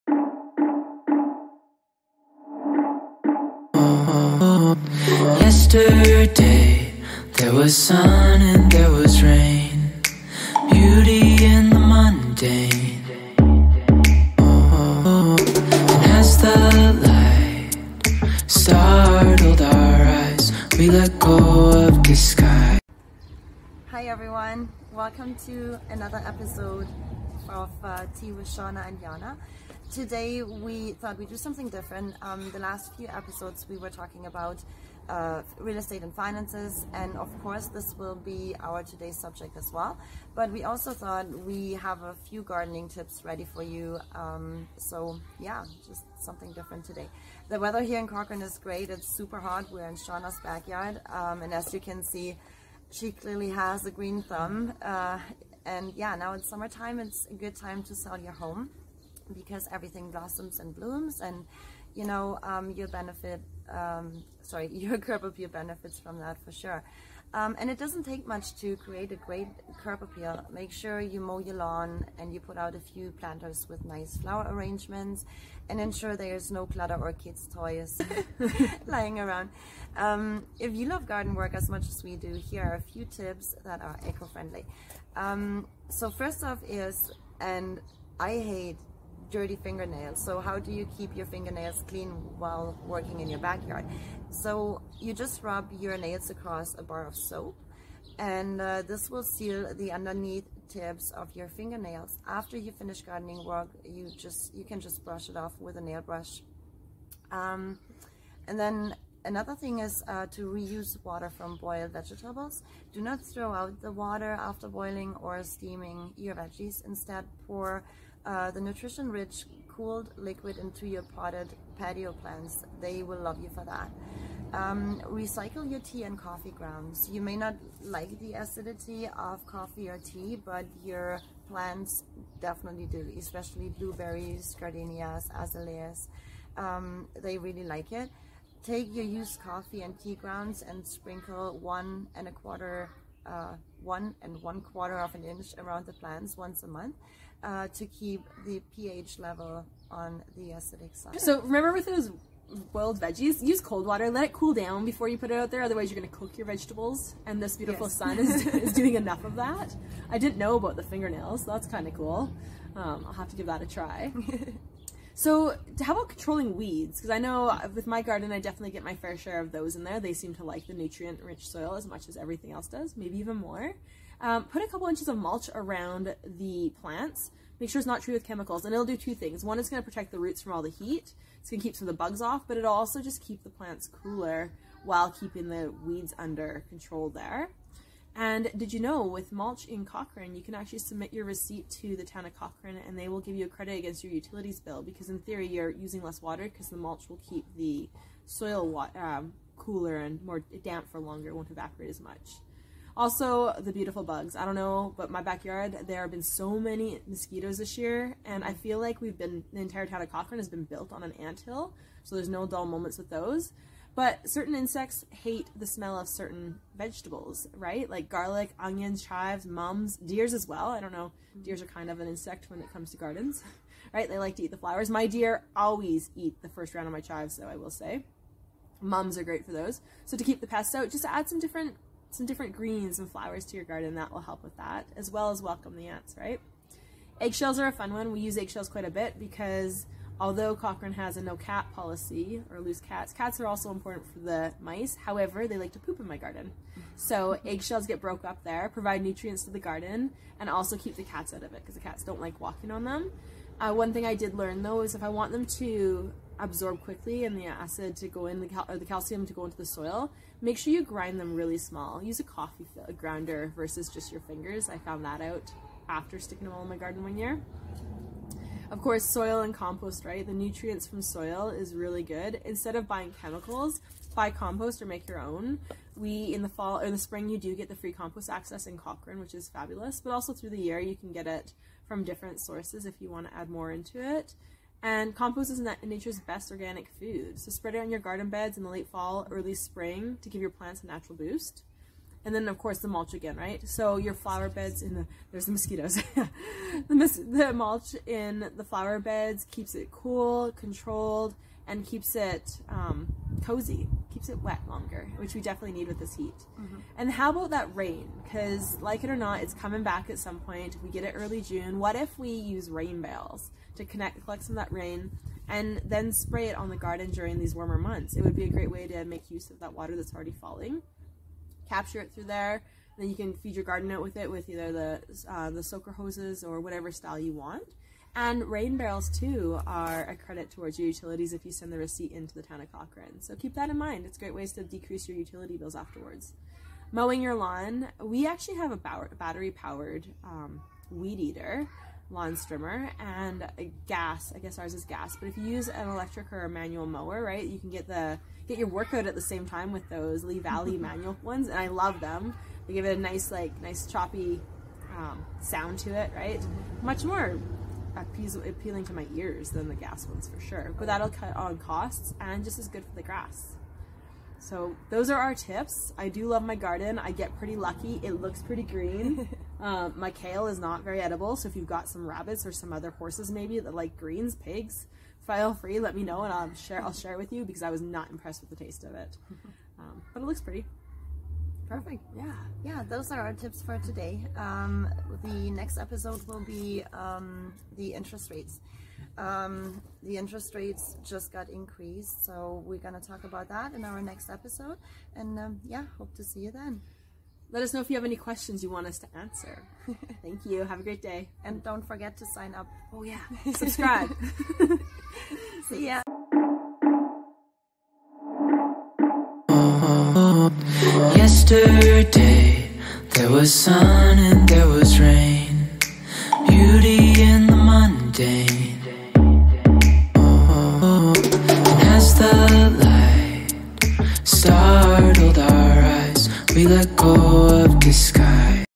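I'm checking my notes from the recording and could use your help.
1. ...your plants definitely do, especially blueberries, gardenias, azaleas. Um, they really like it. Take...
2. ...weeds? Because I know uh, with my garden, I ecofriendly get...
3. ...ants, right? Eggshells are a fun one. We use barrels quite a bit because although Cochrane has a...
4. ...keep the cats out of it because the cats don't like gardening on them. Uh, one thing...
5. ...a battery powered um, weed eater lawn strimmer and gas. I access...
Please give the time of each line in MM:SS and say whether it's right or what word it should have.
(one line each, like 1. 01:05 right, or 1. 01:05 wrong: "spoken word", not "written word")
1. 02:10 right
2. 02:46 wrong: "definitely", not "ecofriendly"
3. 03:55 wrong: "eggshells", not "barrels"
4. 04:10 wrong: "walking", not "gardening"
5. 05:38 wrong: "guess", not "access".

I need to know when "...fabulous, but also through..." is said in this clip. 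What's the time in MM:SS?
04:39.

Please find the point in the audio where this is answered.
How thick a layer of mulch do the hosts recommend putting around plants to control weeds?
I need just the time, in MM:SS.
02:54.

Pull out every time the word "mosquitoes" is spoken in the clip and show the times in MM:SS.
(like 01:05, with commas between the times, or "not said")
03:27, 04:55.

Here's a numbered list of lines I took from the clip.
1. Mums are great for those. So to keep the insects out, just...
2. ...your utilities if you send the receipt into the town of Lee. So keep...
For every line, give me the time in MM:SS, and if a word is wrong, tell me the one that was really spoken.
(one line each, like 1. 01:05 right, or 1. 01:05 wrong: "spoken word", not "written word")
1. 03:48 wrong: "pests", not "insects"
2. 05:30 wrong: "Cochrane", not "Lee".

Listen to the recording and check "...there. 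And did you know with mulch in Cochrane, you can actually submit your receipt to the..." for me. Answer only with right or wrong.
right.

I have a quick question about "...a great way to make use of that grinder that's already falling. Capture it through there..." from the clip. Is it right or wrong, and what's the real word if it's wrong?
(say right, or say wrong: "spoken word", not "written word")
wrong: "water", not "grinder".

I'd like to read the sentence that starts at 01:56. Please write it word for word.
Instead, pour uh, the nutrition-rich cooled liquid into your potted patio plants.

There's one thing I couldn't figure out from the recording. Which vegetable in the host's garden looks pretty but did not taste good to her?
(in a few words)
Kale.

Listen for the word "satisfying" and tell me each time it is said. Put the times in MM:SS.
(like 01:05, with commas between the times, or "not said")
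not said.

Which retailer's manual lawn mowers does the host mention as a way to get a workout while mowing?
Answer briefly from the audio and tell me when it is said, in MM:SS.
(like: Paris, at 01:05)
Lee Valley, at 05:50.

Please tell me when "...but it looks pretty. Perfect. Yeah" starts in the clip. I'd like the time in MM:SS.
06:20.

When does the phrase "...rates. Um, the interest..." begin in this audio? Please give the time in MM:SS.
06:28.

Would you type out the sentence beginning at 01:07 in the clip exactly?
Um, and it doesn't take much to create a great curb appeal.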